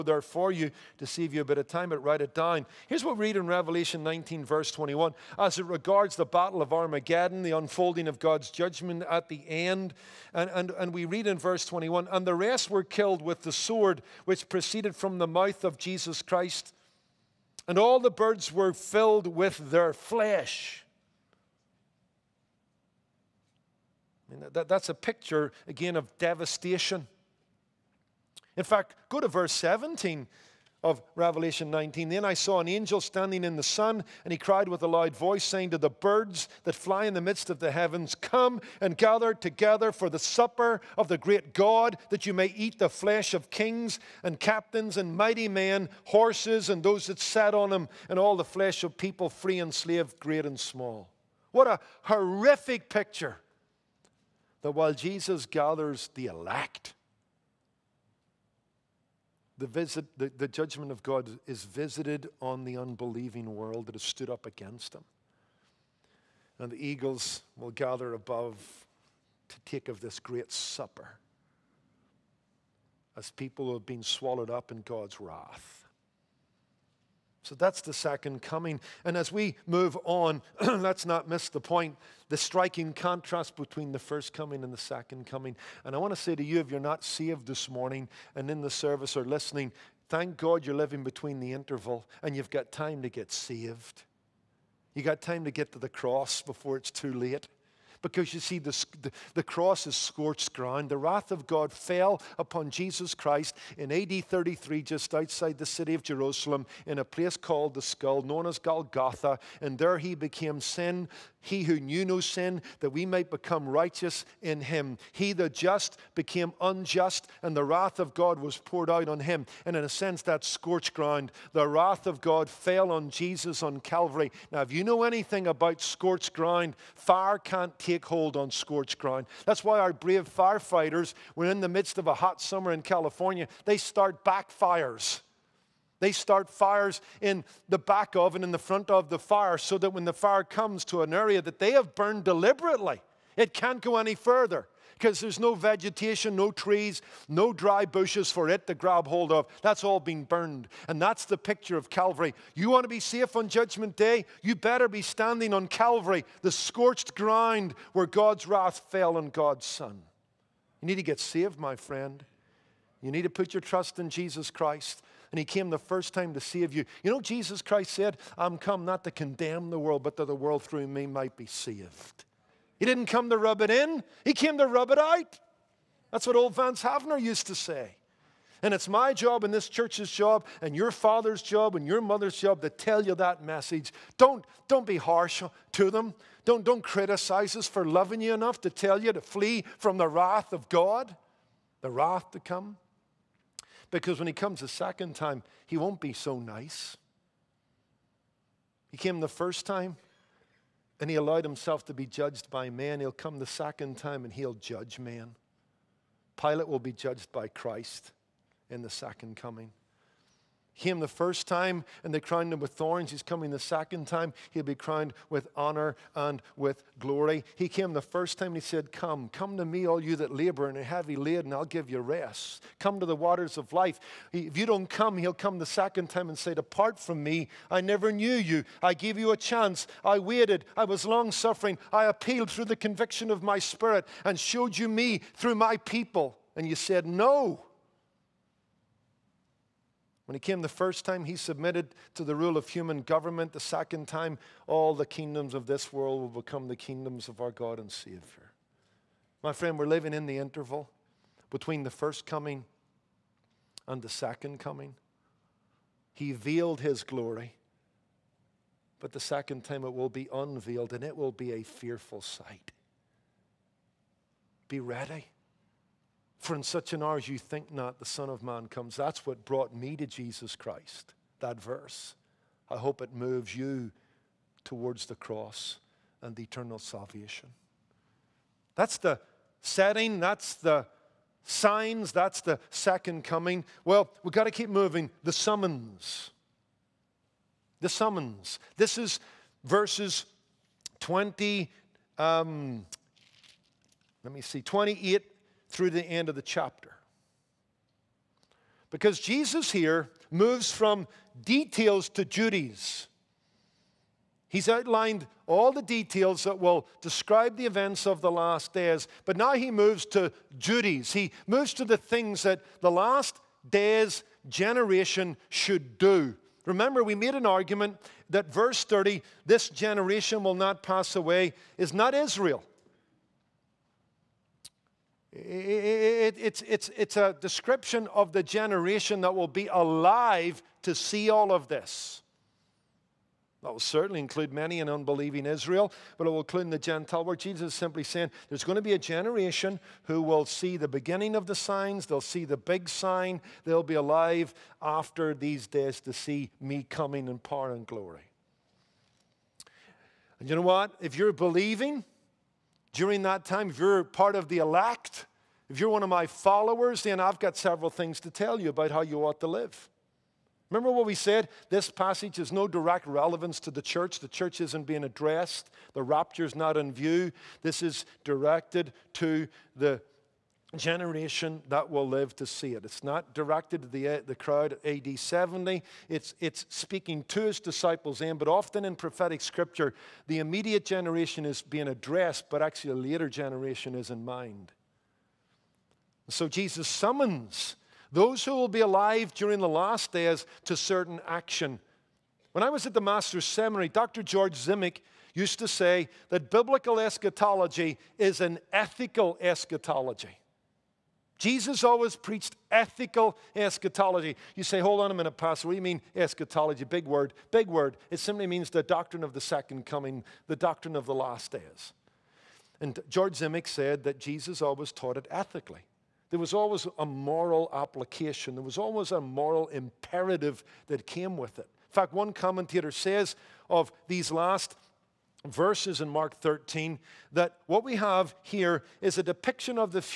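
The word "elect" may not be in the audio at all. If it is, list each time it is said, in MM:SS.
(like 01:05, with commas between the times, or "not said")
00:56, 05:54.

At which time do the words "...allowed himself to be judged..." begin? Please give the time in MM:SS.
03:21.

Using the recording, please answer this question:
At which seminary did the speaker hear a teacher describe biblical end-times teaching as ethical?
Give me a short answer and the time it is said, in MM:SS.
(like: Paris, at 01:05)
The Master's Seminary, at 06:33.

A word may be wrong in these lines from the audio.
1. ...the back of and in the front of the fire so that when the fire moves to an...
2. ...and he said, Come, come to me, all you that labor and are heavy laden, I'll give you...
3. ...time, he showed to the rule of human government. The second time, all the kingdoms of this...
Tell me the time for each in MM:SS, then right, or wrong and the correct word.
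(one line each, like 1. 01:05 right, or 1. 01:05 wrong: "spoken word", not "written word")
1. 02:17 wrong: "comes", not "moves"
2. 03:38 right
3. 04:01 wrong: "submitted", not "showed".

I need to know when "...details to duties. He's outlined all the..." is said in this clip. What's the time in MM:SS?
05:01.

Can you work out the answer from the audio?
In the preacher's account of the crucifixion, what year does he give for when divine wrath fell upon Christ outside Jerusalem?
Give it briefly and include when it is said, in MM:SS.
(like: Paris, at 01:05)
AD 33, at 01:43.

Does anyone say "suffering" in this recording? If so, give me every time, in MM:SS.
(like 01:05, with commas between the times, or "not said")
03:51.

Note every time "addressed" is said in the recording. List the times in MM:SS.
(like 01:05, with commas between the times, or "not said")
06:05, 06:21.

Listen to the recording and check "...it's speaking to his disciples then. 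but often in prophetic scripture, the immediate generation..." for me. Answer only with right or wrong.
right.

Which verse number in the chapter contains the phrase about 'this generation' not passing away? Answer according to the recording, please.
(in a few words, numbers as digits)
30.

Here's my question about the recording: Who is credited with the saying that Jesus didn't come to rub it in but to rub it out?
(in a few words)
Vance Havner.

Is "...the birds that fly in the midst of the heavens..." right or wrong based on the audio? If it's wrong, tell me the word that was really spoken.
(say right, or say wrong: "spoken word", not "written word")
right.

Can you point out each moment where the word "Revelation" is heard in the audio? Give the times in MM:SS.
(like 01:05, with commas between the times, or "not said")
00:03, 00:31.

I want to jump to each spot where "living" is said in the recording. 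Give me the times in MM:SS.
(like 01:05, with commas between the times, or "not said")
01:30, 04:09.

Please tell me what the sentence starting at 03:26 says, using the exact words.
Pilate will be judged by Christ in the second coming him the first time and they crowned him with thorns.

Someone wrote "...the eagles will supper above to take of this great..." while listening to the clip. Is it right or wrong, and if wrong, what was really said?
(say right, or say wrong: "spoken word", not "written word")
wrong: "gather", not "supper".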